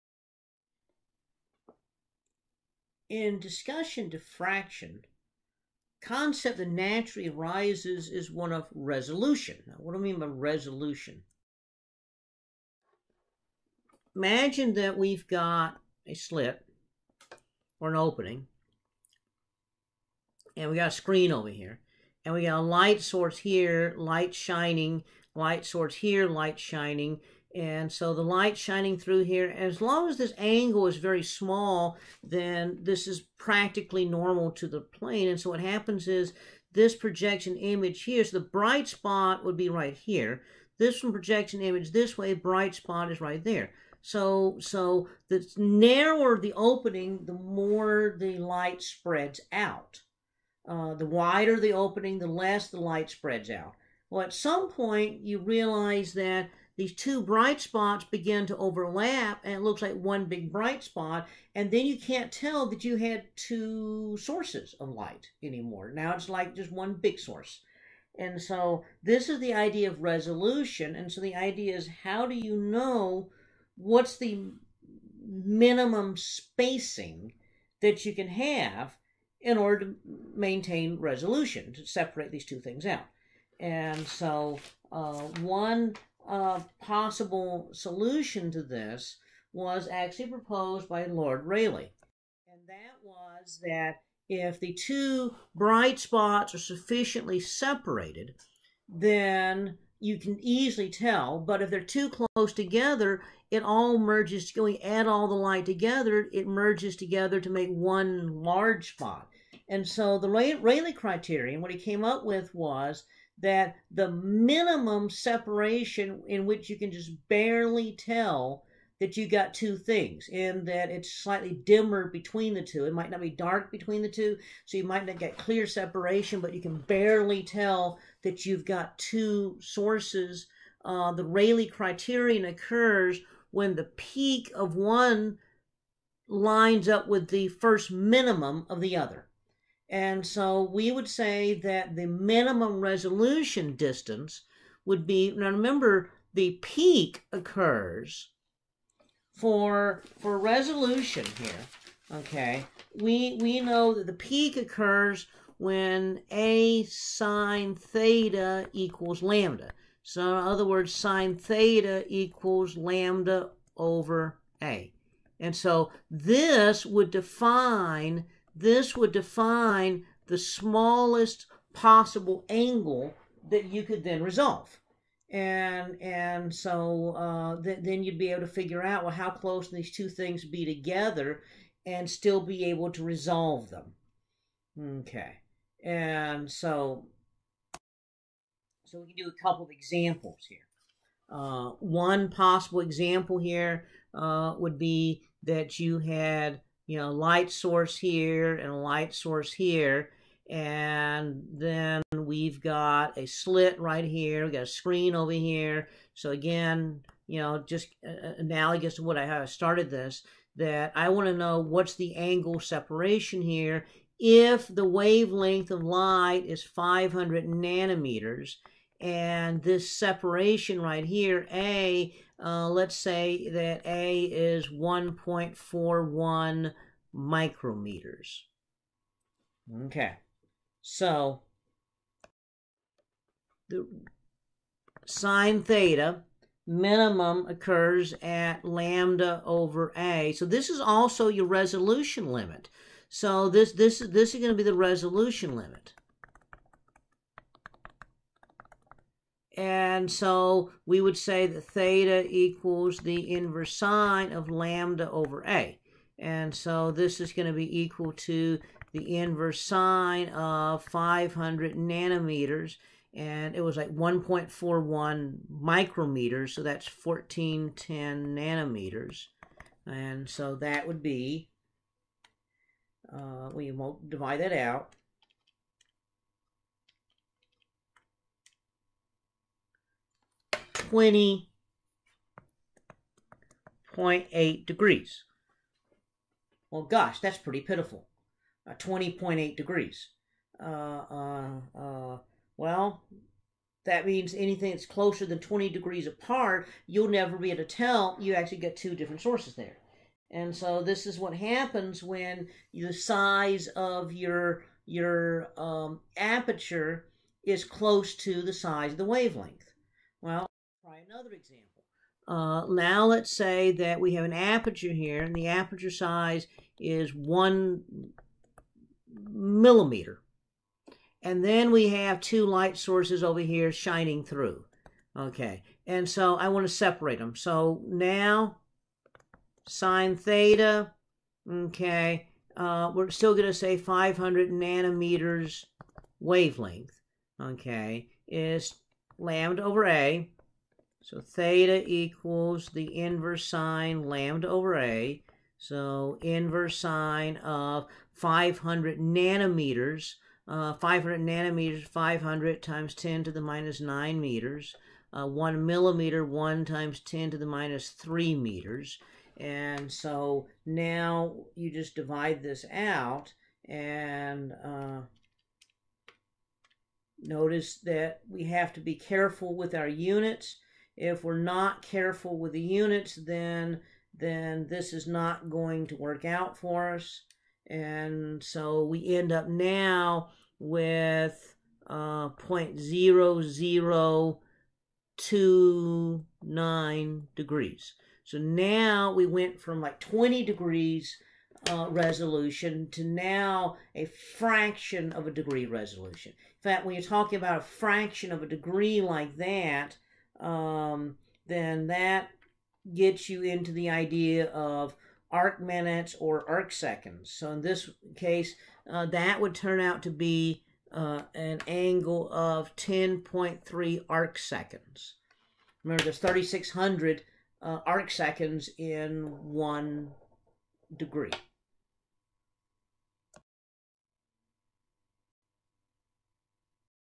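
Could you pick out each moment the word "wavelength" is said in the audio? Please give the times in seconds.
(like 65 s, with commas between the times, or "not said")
214 s, 309 s, 336 s.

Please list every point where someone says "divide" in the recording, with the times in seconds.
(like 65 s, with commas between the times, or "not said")
274 s, 361 s.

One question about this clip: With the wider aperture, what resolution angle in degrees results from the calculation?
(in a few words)
0.0029 degrees.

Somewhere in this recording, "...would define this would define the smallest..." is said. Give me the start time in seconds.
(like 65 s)
166 s.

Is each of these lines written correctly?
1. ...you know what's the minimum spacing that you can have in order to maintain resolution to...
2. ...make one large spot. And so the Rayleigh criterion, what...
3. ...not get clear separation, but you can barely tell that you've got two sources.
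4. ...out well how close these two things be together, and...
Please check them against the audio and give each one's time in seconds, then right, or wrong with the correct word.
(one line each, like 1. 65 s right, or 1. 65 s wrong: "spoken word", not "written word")
1. 72 s right
2. 107 s right
3. 125 s right
4. 178 s right.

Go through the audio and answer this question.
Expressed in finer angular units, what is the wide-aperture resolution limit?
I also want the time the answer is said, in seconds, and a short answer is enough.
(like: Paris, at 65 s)
10.3 arc seconds, at 412 s.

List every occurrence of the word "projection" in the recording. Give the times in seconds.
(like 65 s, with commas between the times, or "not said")
36 s, 41 s.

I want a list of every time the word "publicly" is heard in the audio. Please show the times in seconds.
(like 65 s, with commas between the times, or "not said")
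not said.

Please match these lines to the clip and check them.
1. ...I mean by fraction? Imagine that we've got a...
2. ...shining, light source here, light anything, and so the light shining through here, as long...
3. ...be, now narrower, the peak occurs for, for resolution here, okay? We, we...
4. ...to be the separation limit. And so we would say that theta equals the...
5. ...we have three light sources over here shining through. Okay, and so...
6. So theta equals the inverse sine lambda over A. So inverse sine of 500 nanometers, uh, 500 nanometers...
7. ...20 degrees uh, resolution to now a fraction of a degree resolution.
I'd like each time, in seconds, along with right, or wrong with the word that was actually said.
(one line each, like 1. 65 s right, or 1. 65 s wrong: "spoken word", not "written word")
1. 9 s wrong: "resolution", not "fraction"
2. 24 s wrong: "shining", not "anything"
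3. 145 s wrong: "remember", not "narrower"
4. 244 s wrong: "resolution", not "separation"
5. 321 s wrong: "two", not "three"
6. 341 s right
7. 390 s right.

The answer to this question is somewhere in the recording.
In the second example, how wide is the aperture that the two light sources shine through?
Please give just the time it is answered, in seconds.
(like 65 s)
317 s.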